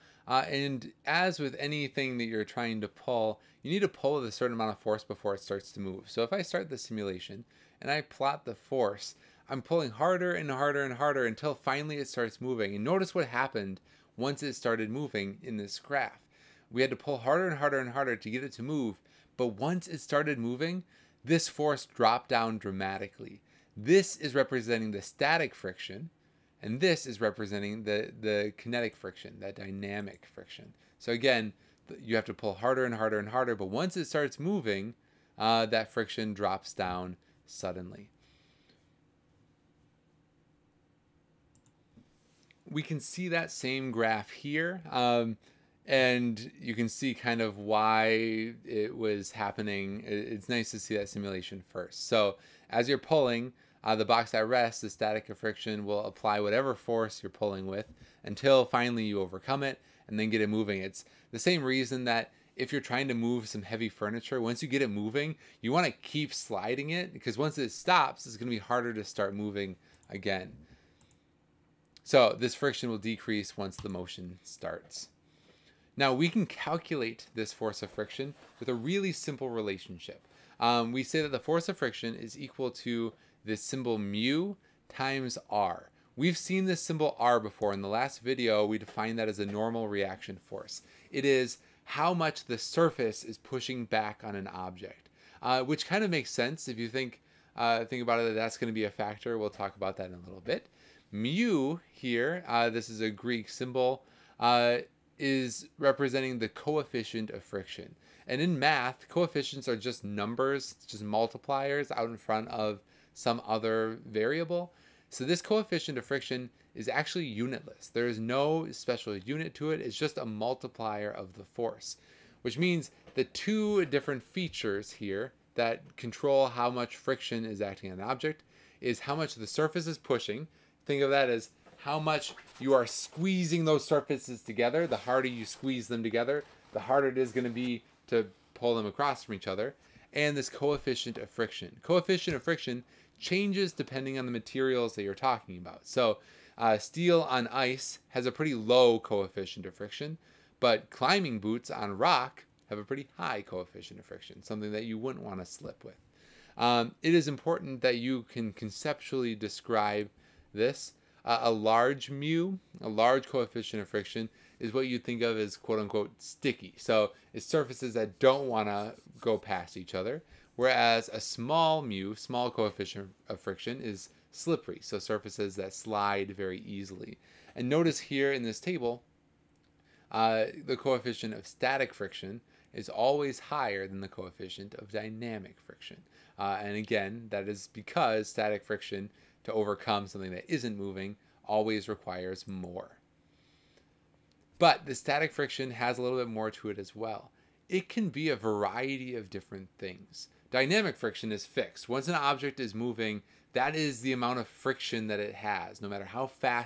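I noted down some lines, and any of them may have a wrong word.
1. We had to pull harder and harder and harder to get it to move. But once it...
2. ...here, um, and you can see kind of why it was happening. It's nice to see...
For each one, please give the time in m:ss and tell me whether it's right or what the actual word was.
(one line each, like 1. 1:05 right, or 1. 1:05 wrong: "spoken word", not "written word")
1. 0:16 right
2. 0:44 right.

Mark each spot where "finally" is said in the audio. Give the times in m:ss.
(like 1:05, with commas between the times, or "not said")
0:11, 0:58.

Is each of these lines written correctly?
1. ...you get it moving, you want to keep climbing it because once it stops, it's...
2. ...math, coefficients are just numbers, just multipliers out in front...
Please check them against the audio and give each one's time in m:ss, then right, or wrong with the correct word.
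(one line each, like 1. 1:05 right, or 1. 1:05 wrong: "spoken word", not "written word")
1. 1:04 wrong: "sliding", not "climbing"
2. 1:48 right.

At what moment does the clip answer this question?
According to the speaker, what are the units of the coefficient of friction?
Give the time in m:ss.
1:57.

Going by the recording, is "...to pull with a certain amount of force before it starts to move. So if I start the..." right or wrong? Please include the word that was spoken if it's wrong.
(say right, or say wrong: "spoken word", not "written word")
right.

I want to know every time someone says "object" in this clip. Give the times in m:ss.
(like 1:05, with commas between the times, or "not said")
1:34, 2:08, 3:22.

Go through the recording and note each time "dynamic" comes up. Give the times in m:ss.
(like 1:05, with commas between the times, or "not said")
0:29, 3:04, 3:20.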